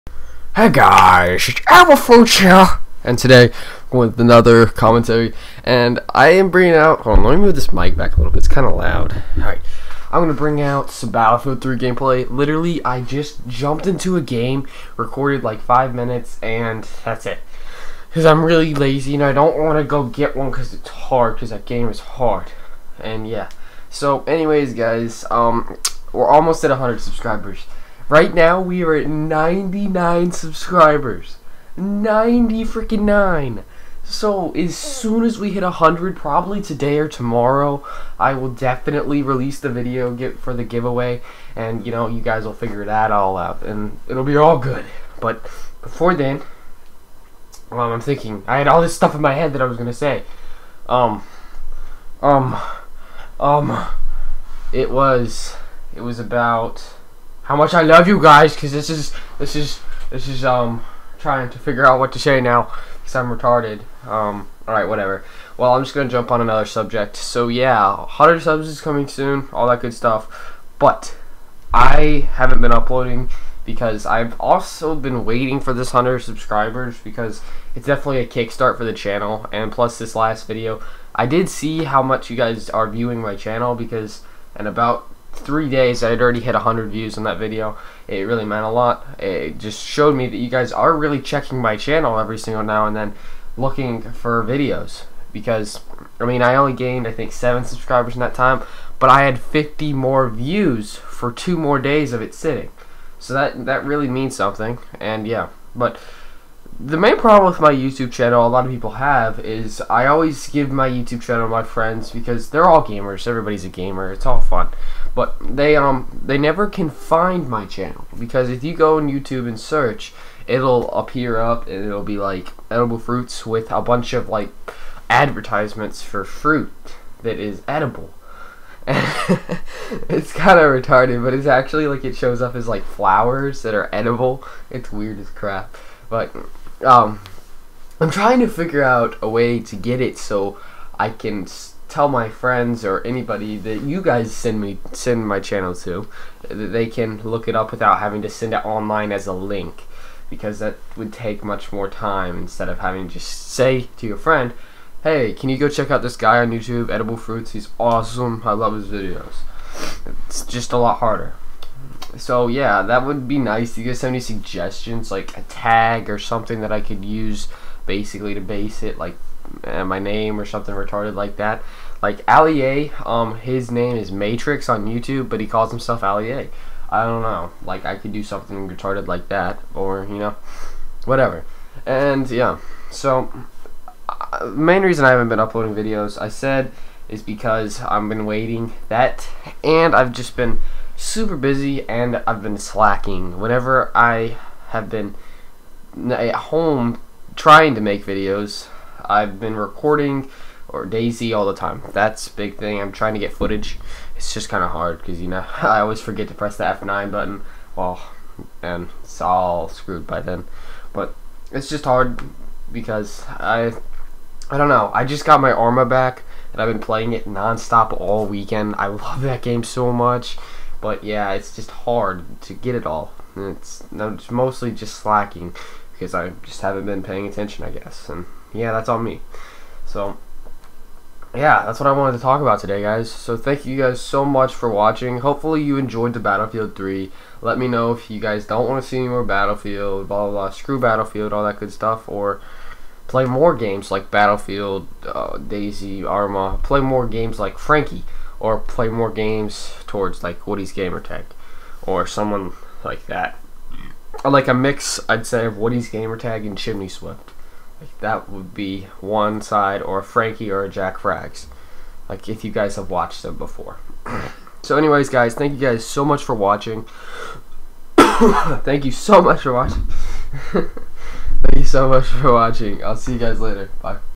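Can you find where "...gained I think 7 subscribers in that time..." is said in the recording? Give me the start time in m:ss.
1:36.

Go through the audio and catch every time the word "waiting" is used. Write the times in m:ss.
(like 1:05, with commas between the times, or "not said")
1:15, 3:08.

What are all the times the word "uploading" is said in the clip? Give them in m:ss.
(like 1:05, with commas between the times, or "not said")
1:12, 3:05.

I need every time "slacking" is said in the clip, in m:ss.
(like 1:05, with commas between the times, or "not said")
3:12, 3:44.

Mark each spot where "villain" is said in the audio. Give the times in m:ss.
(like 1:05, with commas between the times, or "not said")
not said.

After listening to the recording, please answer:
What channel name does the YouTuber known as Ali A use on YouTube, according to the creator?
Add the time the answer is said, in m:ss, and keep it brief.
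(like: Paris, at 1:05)
Matrix, at 2:54.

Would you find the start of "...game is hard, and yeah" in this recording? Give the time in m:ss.
0:21.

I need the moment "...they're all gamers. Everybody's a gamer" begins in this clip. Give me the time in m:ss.
1:52.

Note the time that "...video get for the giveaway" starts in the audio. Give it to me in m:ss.
0:39.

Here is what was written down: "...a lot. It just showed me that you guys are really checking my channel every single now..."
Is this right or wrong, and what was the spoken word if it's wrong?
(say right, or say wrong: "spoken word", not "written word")
right.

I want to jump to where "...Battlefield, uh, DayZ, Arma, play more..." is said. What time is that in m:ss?
4:04.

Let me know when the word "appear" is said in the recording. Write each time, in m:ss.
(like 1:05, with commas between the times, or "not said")
2:00.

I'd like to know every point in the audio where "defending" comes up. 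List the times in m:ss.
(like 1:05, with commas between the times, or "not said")
not said.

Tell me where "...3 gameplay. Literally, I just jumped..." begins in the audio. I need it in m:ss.
0:11.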